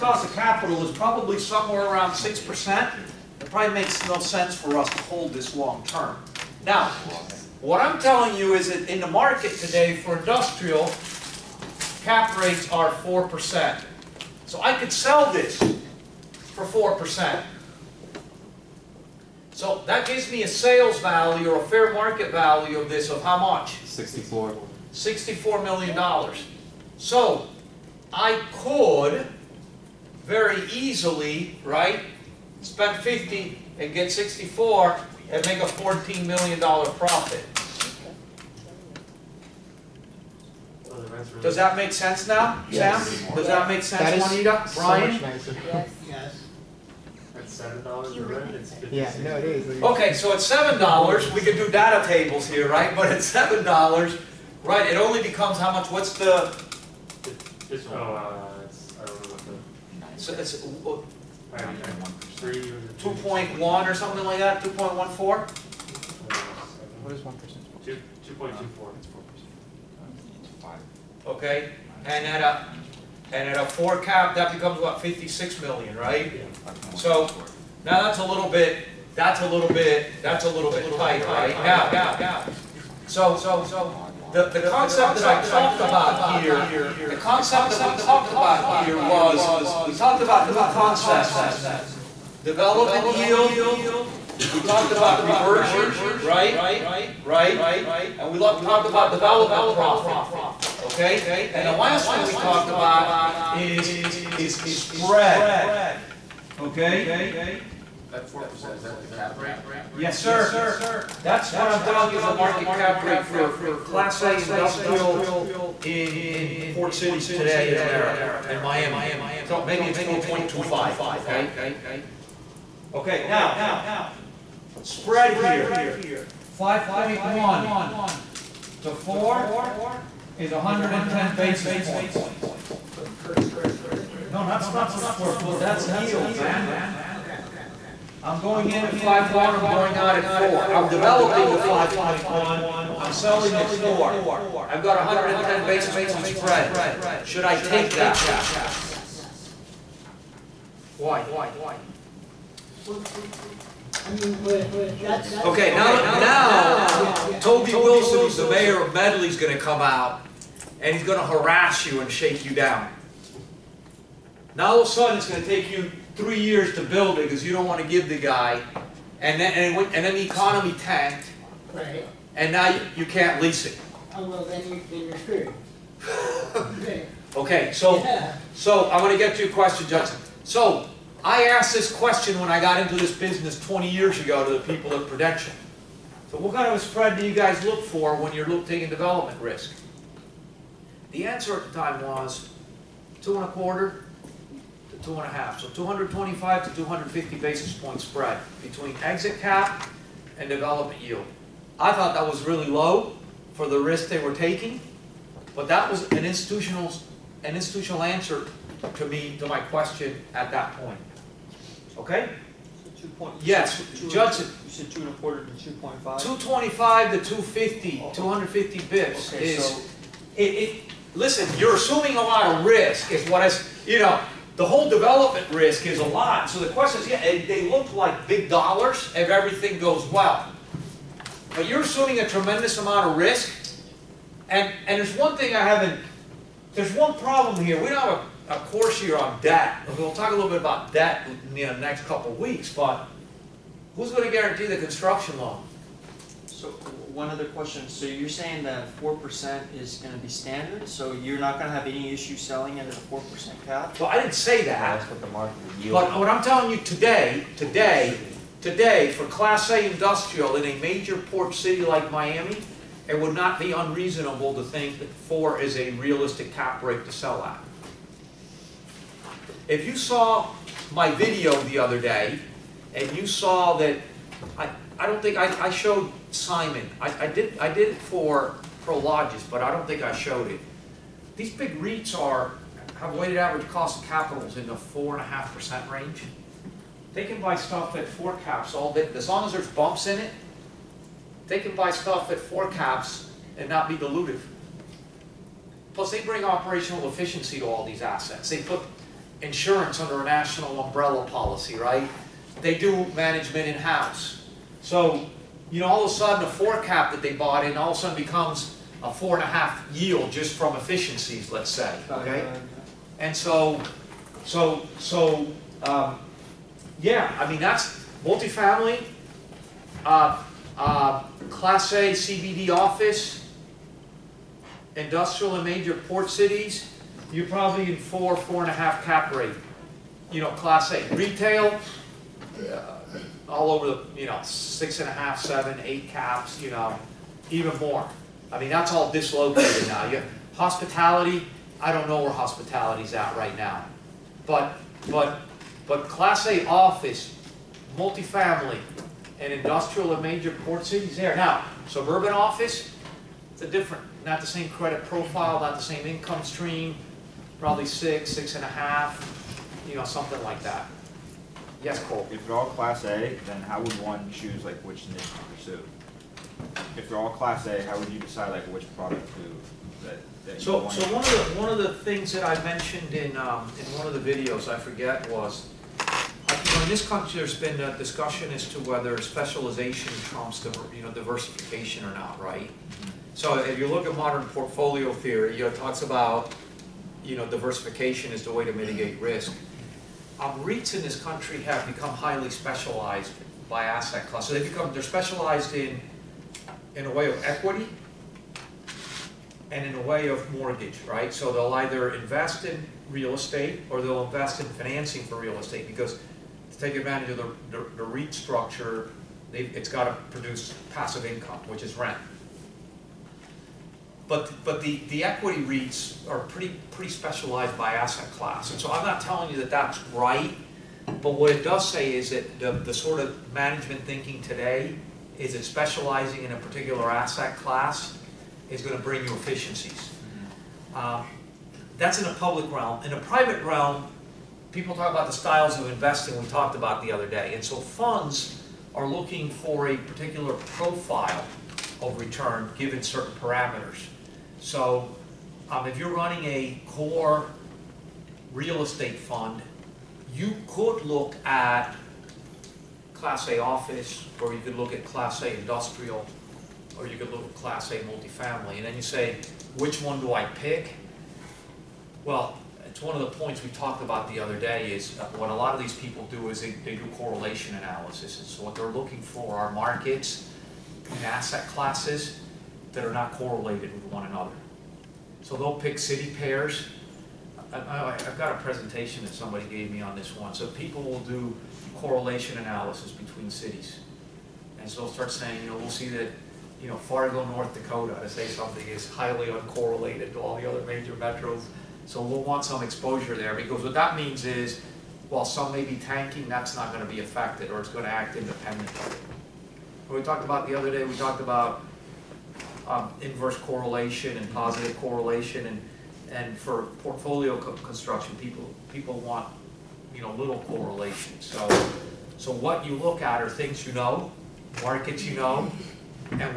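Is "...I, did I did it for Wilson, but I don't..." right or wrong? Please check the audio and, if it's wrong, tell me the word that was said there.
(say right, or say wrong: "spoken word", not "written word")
wrong: "Prologis", not "Wilson".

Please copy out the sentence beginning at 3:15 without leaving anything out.
So 225 to 250 basis point spread between exit cap and development yield.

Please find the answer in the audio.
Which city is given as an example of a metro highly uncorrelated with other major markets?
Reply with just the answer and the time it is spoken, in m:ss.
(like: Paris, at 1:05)
Fargo, North Dakota, at 8:06.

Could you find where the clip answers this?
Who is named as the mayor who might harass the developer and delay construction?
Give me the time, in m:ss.
2:37.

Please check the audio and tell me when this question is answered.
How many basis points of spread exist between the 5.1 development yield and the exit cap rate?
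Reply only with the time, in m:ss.
2:10.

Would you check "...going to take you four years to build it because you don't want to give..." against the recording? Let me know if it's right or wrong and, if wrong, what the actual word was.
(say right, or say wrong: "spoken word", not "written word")
wrong: "three", not "four".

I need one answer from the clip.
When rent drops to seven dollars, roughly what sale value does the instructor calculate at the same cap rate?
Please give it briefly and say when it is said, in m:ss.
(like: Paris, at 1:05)
56 million, at 1:15.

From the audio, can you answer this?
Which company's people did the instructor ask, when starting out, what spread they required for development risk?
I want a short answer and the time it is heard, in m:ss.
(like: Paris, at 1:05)
Prudential, at 3:05.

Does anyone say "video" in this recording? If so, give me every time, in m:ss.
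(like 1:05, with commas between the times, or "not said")
4:31, 6:14.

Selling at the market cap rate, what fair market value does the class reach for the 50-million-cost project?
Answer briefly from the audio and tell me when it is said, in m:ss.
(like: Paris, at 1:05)
$64 million, at 0:24.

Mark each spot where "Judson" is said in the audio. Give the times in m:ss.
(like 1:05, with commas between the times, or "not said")
2:59, 3:34.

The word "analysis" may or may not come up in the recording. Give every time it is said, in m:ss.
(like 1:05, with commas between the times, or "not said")
7:47, 8:02.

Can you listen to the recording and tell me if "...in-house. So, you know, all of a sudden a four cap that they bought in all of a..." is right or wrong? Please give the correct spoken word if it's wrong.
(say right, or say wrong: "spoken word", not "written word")
right.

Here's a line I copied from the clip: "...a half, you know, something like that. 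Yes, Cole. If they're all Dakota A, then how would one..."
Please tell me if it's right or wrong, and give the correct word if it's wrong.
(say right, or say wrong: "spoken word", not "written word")
wrong: "Class", not "Dakota".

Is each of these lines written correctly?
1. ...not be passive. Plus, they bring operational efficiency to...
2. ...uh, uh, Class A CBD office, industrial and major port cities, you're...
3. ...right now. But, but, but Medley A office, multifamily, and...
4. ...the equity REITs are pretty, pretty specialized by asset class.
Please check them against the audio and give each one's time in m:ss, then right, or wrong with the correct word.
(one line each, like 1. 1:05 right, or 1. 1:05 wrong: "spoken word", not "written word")
1. 4:53 wrong: "dilutive", not "passive"
2. 5:20 right
3. 5:43 wrong: "Class", not "Medley"
4. 6:55 right.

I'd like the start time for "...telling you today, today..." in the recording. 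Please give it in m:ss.
4:16.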